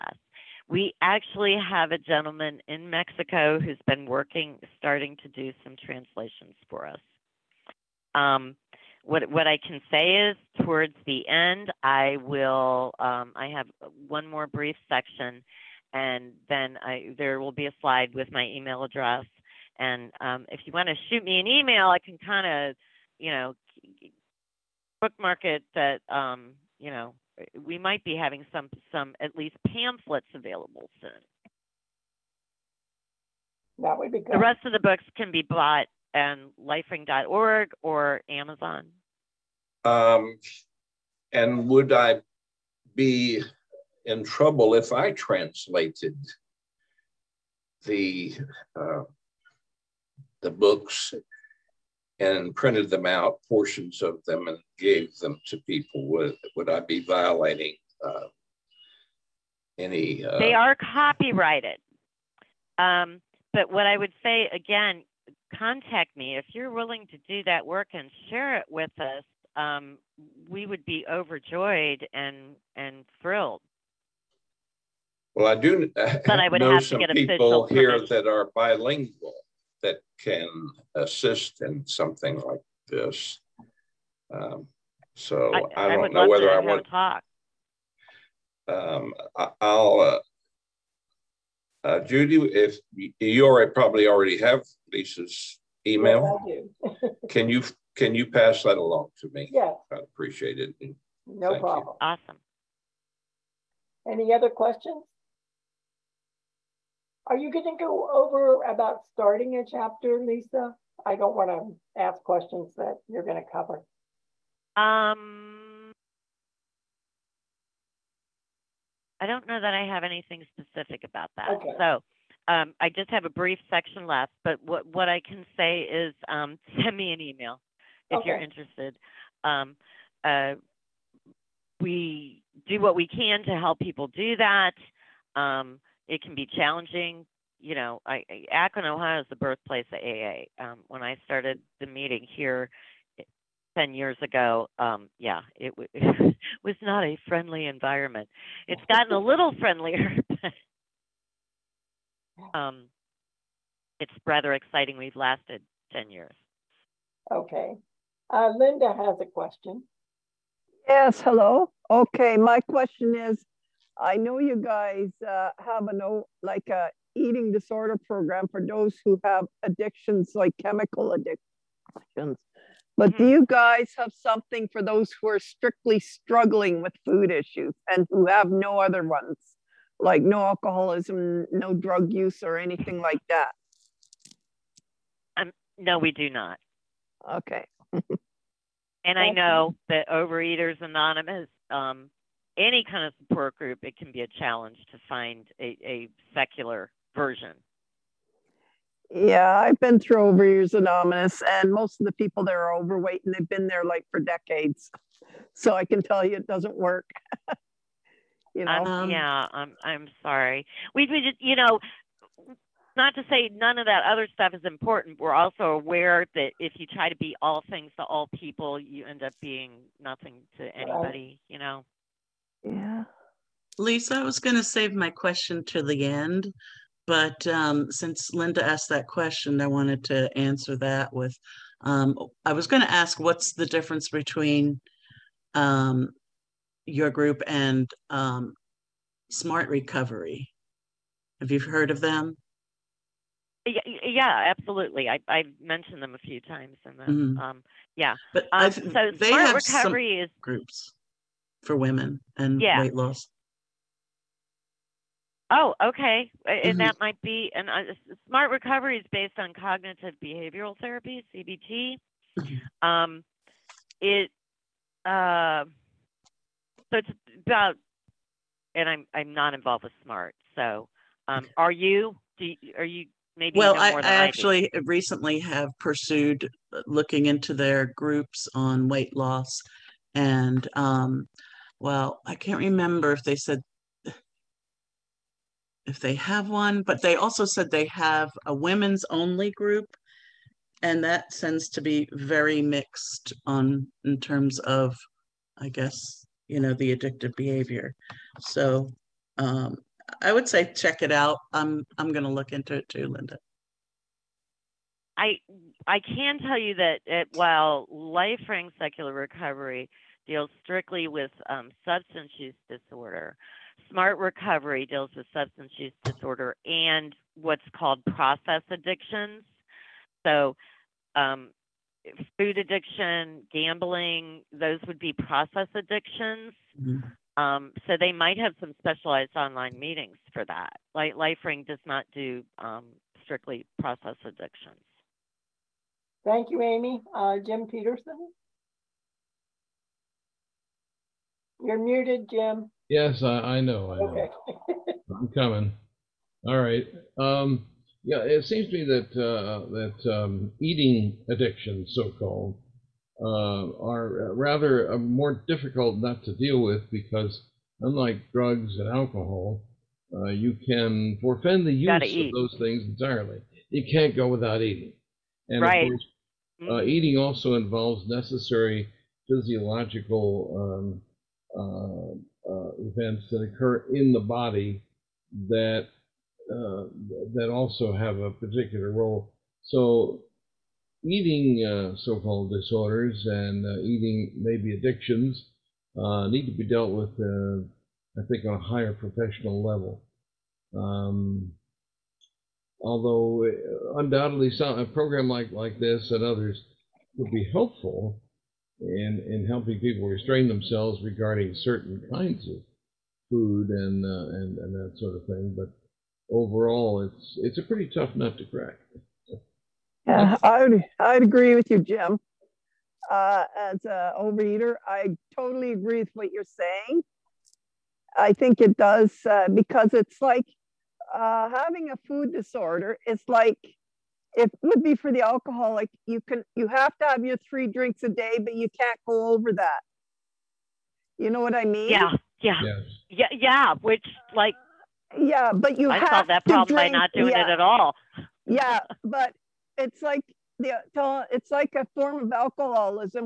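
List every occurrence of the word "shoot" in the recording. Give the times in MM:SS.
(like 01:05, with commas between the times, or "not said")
00:21.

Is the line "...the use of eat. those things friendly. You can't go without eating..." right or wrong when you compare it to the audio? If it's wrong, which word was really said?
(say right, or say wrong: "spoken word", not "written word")
wrong: "entirely", not "friendly".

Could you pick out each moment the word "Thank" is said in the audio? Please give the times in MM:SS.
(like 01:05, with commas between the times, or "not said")
01:41, 05:36.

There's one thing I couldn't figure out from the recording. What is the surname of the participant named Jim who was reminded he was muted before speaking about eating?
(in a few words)
Peterson.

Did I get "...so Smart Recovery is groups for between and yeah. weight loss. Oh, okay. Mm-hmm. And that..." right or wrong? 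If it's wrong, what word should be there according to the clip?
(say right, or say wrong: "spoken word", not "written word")
wrong: "women", not "between".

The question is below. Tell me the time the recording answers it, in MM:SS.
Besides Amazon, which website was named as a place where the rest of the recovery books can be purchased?
00:36.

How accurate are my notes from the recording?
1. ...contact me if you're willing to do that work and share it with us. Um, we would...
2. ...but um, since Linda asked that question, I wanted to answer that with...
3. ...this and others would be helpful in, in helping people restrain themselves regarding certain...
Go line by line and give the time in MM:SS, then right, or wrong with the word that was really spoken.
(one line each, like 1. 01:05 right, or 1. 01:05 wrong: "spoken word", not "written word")
1. 01:05 right
2. 03:47 right
3. 06:35 right.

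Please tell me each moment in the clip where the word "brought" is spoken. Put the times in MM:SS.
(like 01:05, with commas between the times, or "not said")
not said.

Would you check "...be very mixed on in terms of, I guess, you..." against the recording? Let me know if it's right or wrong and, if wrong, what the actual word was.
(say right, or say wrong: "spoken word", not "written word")
right.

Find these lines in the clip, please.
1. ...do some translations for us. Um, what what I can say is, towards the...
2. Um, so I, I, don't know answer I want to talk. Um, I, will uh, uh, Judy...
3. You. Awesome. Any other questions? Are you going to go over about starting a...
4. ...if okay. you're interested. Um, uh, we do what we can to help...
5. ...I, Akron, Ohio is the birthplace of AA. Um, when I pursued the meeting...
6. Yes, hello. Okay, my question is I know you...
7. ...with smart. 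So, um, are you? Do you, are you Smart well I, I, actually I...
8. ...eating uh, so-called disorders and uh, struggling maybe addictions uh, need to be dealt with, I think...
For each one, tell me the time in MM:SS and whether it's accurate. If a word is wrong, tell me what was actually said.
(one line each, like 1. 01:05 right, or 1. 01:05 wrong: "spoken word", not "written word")
1. 00:05 right
2. 01:24 wrong: "whether", not "answer"
3. 01:42 right
4. 02:08 right
5. 02:18 wrong: "started", not "pursued"
6. 02:40 right
7. 04:29 wrong: "Maybe", not "Smart"
8. 06:21 wrong: "eating", not "struggling".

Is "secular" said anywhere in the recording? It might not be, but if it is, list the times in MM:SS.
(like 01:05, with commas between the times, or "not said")
03:16, 05:08.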